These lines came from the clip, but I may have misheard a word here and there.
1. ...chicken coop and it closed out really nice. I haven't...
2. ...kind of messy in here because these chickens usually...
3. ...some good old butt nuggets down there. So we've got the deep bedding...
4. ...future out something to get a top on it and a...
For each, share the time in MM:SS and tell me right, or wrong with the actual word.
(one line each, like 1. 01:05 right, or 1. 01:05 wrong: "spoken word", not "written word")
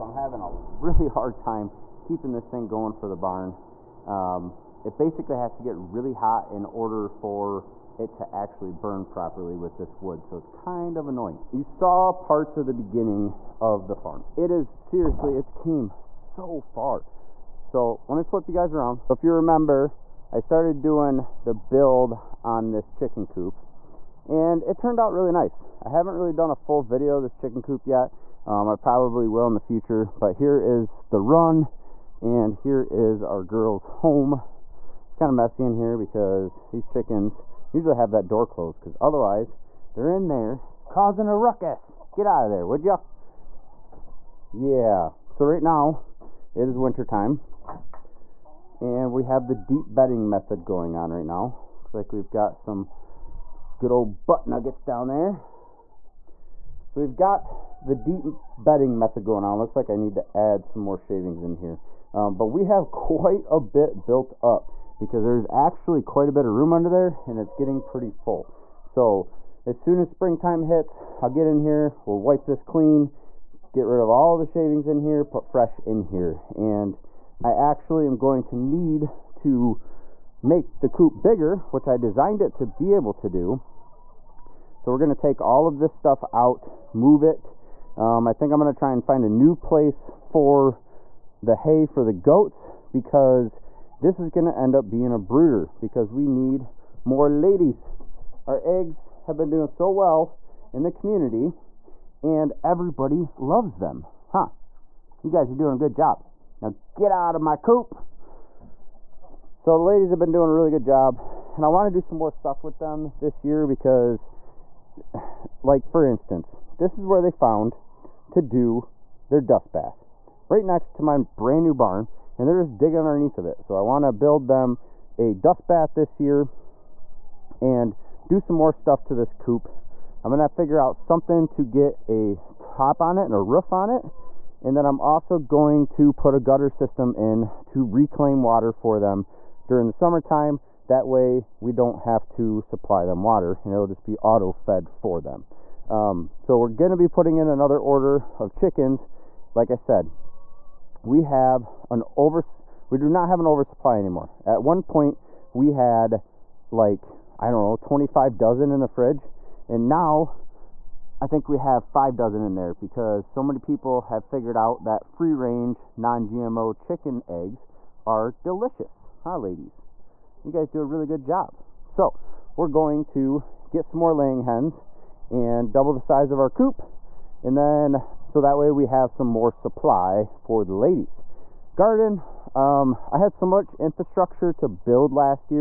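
1. 00:22 wrong: "turned", not "closed"
2. 00:35 right
3. 00:52 right
4. 02:10 wrong: "figure", not "future".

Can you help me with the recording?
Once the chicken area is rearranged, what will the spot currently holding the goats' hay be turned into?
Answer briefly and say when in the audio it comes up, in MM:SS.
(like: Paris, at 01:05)
brooder, at 01:35.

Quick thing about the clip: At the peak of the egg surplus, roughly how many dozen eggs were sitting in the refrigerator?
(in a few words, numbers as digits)
25 dozen.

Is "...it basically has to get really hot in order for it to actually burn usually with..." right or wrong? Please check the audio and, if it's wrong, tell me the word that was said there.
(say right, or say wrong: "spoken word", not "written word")
wrong: "properly", not "usually".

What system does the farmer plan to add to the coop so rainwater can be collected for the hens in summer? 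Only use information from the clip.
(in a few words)
gutter system.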